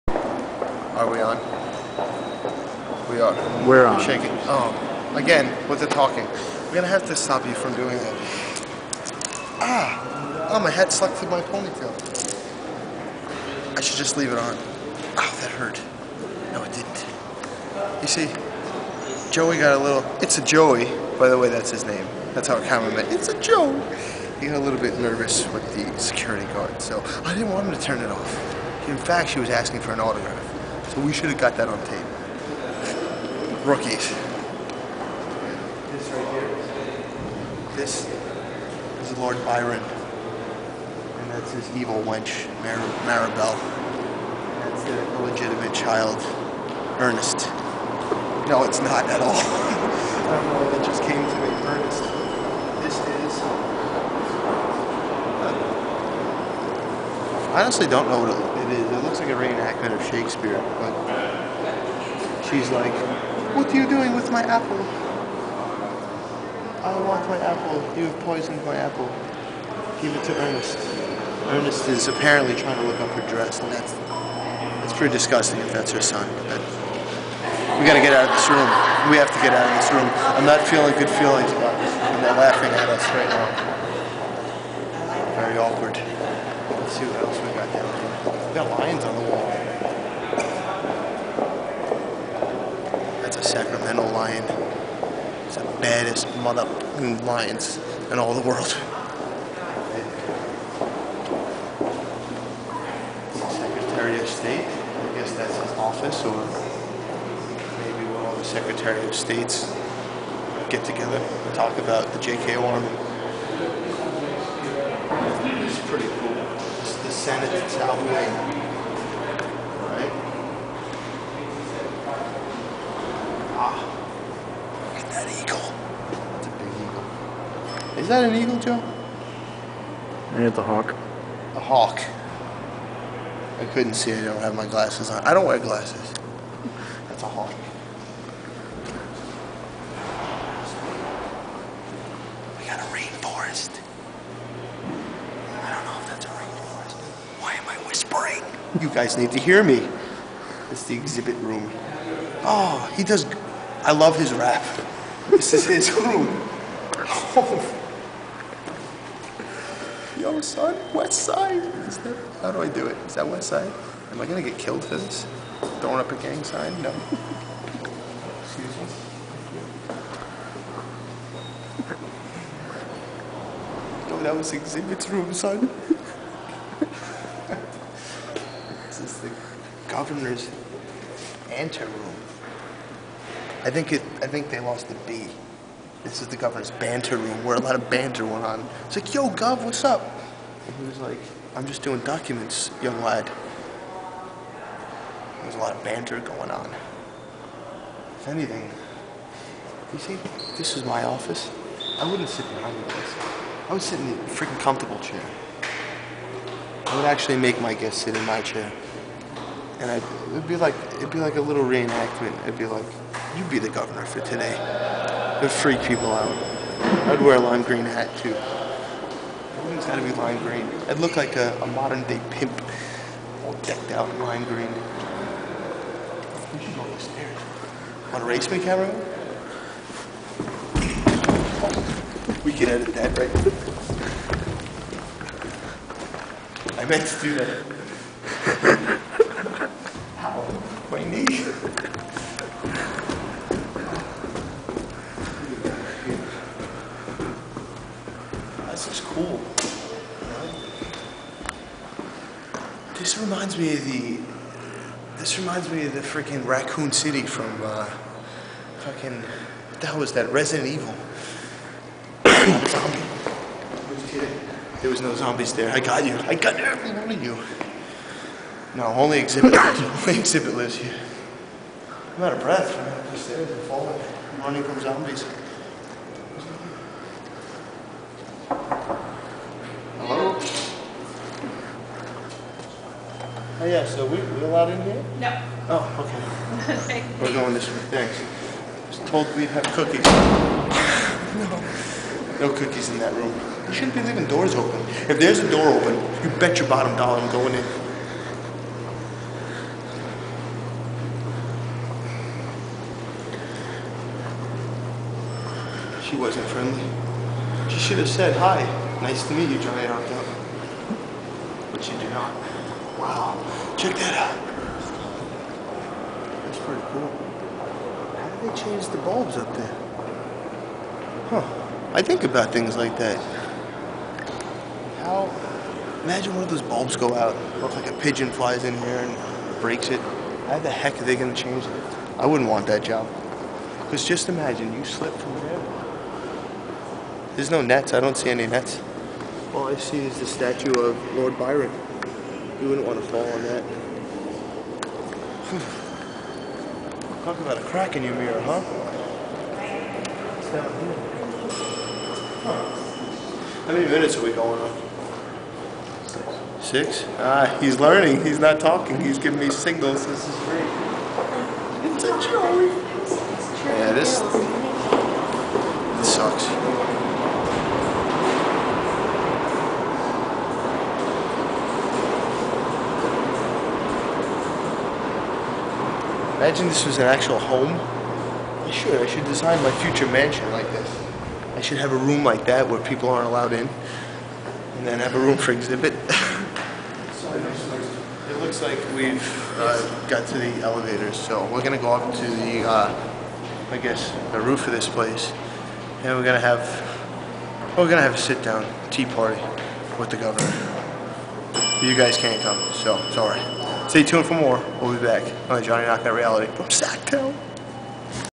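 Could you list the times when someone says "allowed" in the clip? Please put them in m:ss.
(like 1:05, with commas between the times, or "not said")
4:44, 6:23.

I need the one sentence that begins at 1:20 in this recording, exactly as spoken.
I'm not feeling good feelings about this, and they're laughing at us right now.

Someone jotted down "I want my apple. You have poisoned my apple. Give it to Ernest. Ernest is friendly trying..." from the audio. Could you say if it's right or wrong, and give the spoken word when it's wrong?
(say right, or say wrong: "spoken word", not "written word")
wrong: "apparently", not "friendly".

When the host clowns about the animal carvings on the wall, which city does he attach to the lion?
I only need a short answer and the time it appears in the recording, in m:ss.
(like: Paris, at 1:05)
Sacramento, at 1:33.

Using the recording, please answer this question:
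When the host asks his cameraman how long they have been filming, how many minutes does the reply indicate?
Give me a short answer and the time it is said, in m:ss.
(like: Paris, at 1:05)
6, at 5:56.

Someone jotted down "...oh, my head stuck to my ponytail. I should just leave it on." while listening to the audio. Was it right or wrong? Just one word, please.
right.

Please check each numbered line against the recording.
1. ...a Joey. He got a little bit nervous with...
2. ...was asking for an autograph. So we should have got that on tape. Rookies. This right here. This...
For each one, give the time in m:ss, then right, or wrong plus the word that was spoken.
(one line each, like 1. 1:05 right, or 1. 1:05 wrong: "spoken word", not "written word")
1. 0:23 right
2. 0:29 right.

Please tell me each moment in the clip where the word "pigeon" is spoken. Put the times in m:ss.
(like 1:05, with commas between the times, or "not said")
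5:27.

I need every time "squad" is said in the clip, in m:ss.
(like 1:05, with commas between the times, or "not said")
not said.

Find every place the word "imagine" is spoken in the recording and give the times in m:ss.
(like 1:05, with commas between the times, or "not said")
5:26, 5:34, 6:16.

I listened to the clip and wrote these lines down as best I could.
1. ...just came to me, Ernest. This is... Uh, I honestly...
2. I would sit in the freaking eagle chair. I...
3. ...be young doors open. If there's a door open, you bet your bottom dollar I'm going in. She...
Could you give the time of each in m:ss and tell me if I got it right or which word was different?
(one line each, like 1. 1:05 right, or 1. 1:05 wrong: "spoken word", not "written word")
1. 0:50 right
2. 3:23 wrong: "comfortable", not "eagle"
3. 4:53 wrong: "leaving", not "young".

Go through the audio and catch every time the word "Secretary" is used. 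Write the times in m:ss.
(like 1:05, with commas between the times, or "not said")
1:43, 1:48.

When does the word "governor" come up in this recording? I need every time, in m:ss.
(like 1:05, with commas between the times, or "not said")
2:59, 3:06, 3:33, 6:40.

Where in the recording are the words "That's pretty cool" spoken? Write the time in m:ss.
5:16.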